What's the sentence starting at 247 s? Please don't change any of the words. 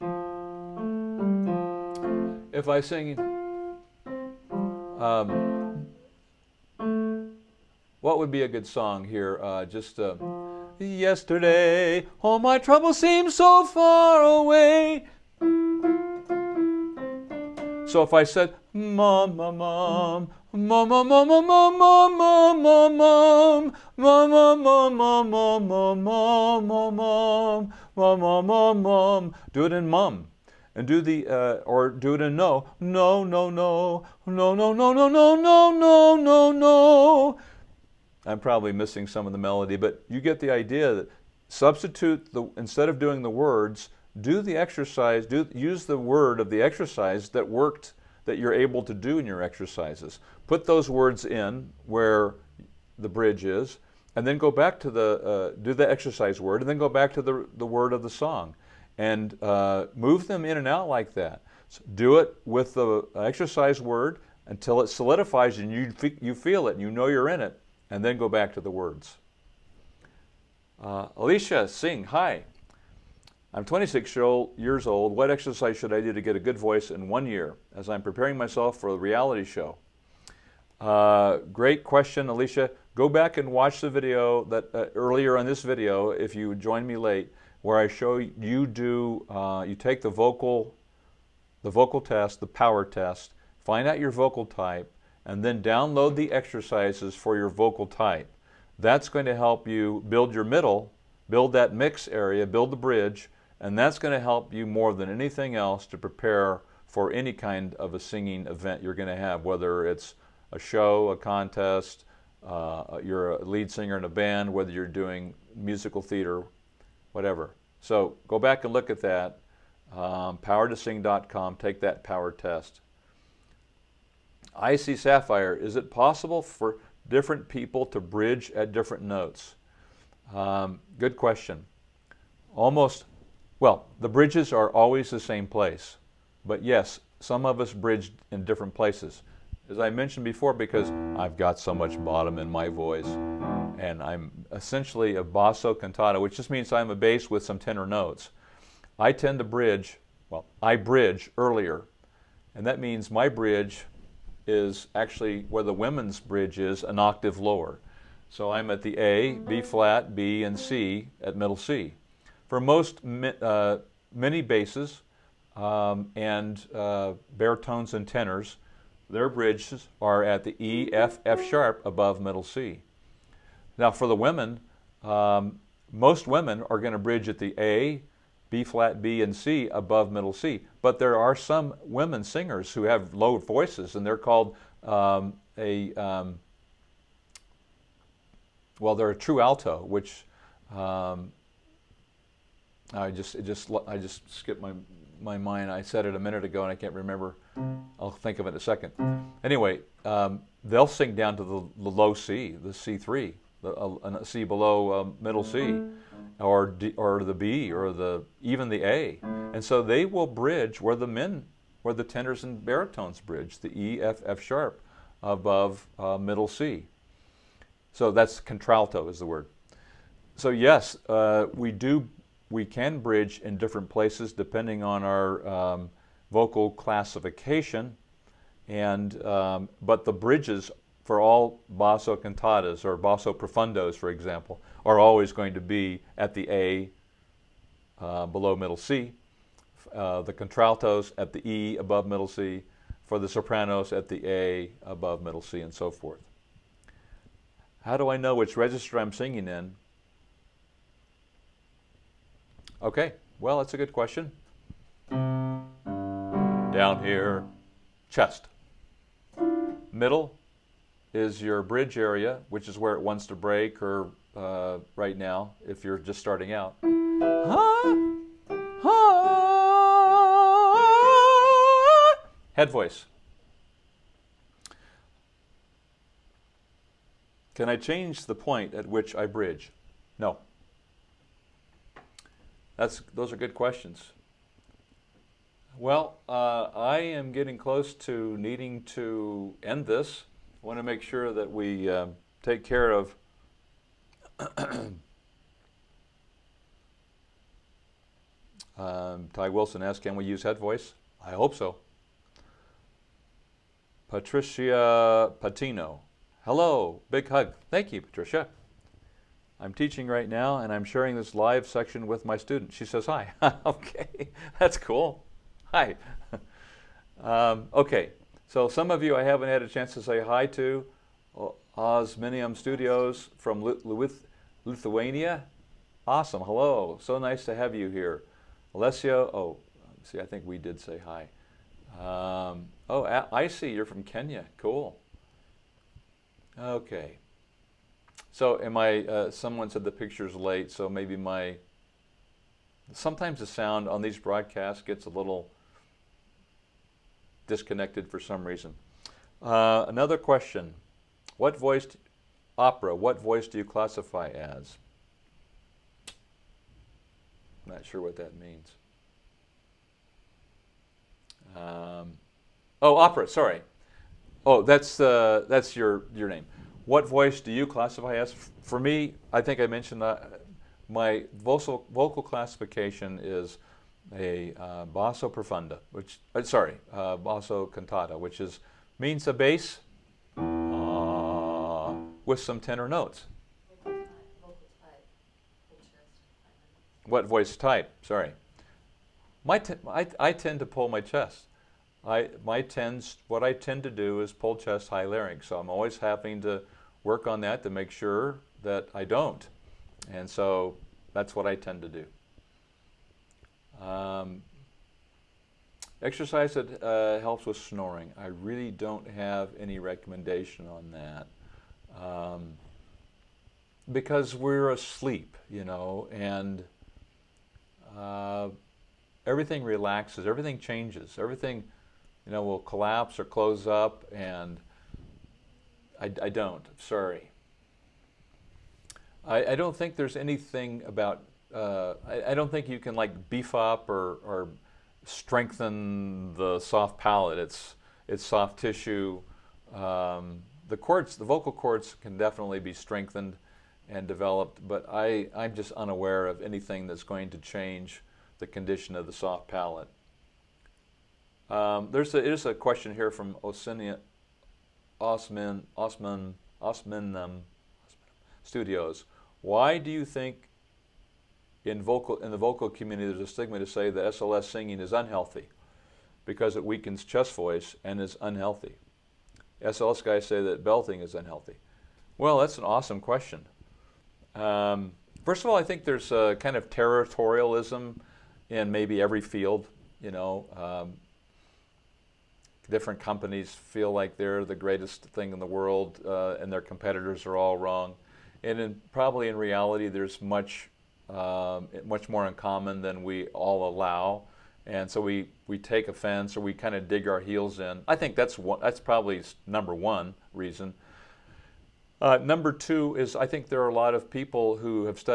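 How do I know which register I'm singing in?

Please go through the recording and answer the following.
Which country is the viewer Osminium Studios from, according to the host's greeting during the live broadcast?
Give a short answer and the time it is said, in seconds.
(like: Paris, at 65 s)
Lithuania, at 324 s.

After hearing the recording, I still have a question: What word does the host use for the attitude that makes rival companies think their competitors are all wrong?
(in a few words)
territorialism.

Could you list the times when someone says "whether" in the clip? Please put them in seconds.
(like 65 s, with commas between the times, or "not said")
109 s, 114 s.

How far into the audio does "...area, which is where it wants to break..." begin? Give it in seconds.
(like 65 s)
261 s.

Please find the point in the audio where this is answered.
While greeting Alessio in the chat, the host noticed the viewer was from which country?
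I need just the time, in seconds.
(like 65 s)
334 s.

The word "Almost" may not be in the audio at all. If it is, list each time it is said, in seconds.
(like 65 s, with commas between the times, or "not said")
132 s.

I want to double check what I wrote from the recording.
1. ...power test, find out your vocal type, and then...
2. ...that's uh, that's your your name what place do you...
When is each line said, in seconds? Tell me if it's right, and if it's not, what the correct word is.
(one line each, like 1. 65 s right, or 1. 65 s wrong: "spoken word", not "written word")
1. 92 s right
2. 364 s wrong: "voice", not "place".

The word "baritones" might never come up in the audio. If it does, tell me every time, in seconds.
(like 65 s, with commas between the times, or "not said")
167 s, 212 s.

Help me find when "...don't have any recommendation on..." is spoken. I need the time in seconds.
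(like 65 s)
408 s.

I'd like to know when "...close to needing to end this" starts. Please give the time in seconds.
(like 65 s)
287 s.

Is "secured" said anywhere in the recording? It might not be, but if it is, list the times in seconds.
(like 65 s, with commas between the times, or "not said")
not said.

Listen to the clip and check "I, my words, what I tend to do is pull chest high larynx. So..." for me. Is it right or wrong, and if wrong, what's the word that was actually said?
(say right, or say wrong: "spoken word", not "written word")
wrong: "tends", not "words".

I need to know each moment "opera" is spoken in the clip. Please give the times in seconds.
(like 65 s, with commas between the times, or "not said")
352 s, 362 s.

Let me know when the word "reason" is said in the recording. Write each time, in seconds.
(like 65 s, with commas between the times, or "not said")
348 s, 500 s.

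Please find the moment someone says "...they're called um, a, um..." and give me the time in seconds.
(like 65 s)
184 s.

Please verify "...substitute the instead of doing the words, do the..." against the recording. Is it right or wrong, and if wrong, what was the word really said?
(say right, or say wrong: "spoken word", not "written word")
right.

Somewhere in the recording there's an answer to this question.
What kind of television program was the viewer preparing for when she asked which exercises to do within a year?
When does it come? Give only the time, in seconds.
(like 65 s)
78 s.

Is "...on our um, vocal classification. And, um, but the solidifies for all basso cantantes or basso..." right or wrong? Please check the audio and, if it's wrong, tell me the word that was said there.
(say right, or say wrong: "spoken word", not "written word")
wrong: "bridges", not "solidifies".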